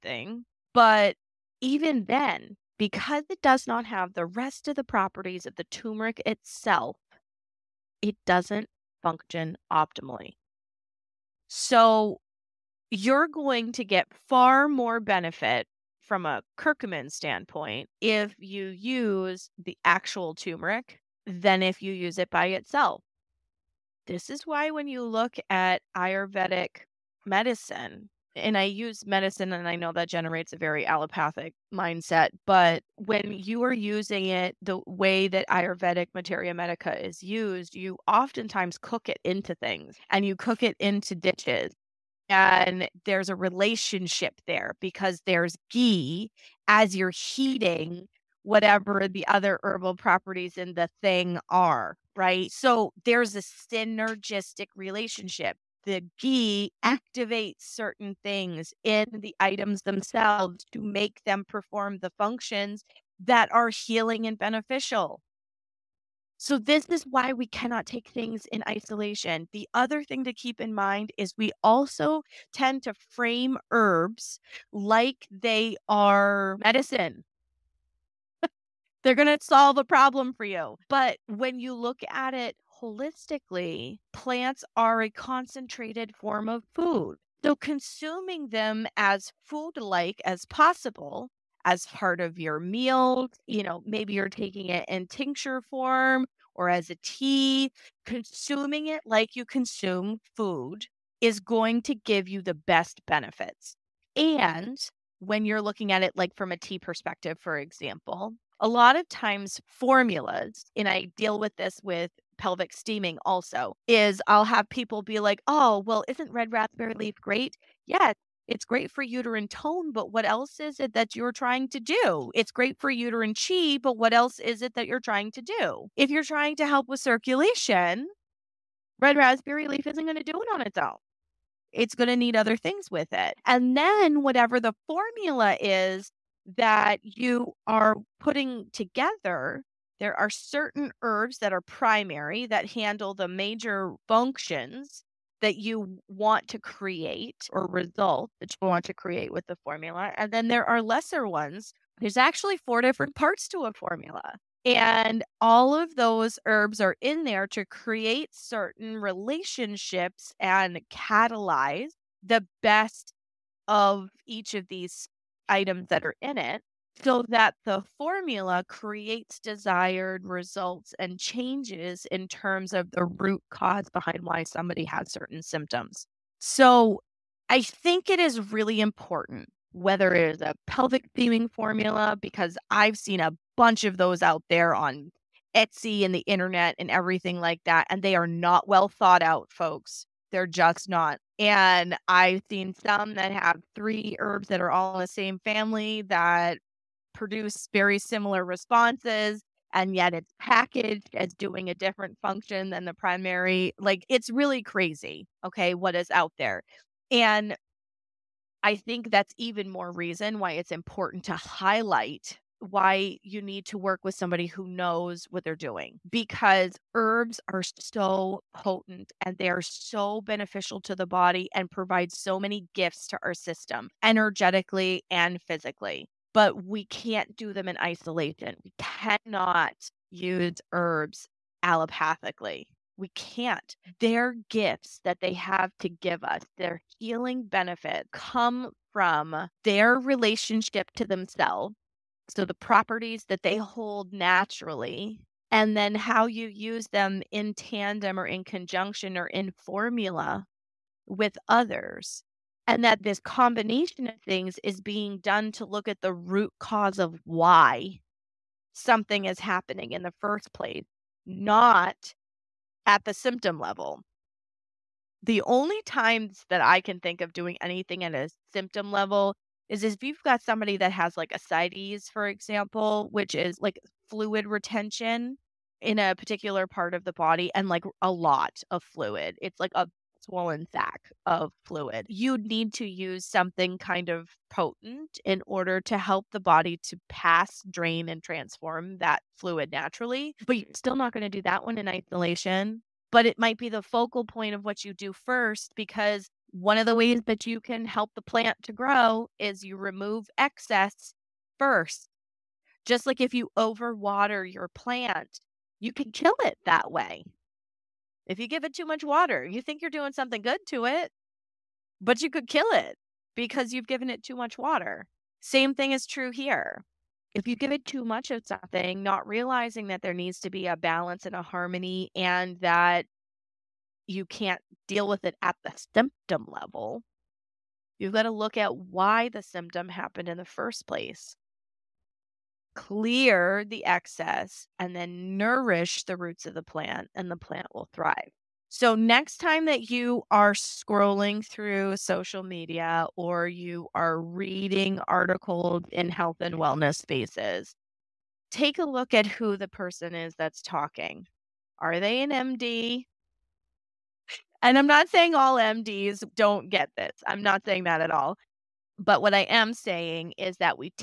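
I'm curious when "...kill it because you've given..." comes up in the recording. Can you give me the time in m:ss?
5:12.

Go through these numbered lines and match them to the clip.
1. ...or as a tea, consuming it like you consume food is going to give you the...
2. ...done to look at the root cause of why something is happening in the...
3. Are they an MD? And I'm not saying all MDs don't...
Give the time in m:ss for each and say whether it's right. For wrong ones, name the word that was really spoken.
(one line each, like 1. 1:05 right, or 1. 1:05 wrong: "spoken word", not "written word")
1. 1:36 right
2. 4:15 right
3. 5:51 right.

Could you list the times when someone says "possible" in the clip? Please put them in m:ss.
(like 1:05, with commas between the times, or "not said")
1:30.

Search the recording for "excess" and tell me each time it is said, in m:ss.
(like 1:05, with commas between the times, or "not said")
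5:00, 5:33.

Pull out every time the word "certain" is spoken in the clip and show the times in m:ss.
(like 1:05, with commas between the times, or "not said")
0:57, 2:20, 2:38, 2:55.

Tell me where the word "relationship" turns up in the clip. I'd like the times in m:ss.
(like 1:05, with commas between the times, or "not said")
0:43, 0:54, 2:38, 3:59.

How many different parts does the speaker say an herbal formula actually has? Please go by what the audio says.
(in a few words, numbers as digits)
4.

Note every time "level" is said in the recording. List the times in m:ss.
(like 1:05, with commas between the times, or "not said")
4:23, 4:28, 5:26.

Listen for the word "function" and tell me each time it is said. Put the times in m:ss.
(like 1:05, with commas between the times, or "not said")
0:09, 1:02, 2:24, 3:22.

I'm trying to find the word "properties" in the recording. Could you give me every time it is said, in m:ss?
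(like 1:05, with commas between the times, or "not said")
0:04, 0:49, 4:02.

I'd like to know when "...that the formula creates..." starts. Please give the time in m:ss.
2:47.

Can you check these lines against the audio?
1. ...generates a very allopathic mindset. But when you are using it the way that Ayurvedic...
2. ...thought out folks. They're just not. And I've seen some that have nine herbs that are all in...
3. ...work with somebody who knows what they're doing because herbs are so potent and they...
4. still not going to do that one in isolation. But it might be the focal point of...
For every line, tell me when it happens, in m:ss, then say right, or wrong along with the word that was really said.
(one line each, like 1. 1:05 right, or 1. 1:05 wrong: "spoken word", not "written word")
1. 0:30 right
2. 3:08 wrong: "three", not "nine"
3. 3:33 right
4. 4:50 right.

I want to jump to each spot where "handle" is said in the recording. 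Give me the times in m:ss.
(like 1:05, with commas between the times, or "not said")
2:22.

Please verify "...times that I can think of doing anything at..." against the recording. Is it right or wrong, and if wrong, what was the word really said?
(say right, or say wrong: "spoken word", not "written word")
right.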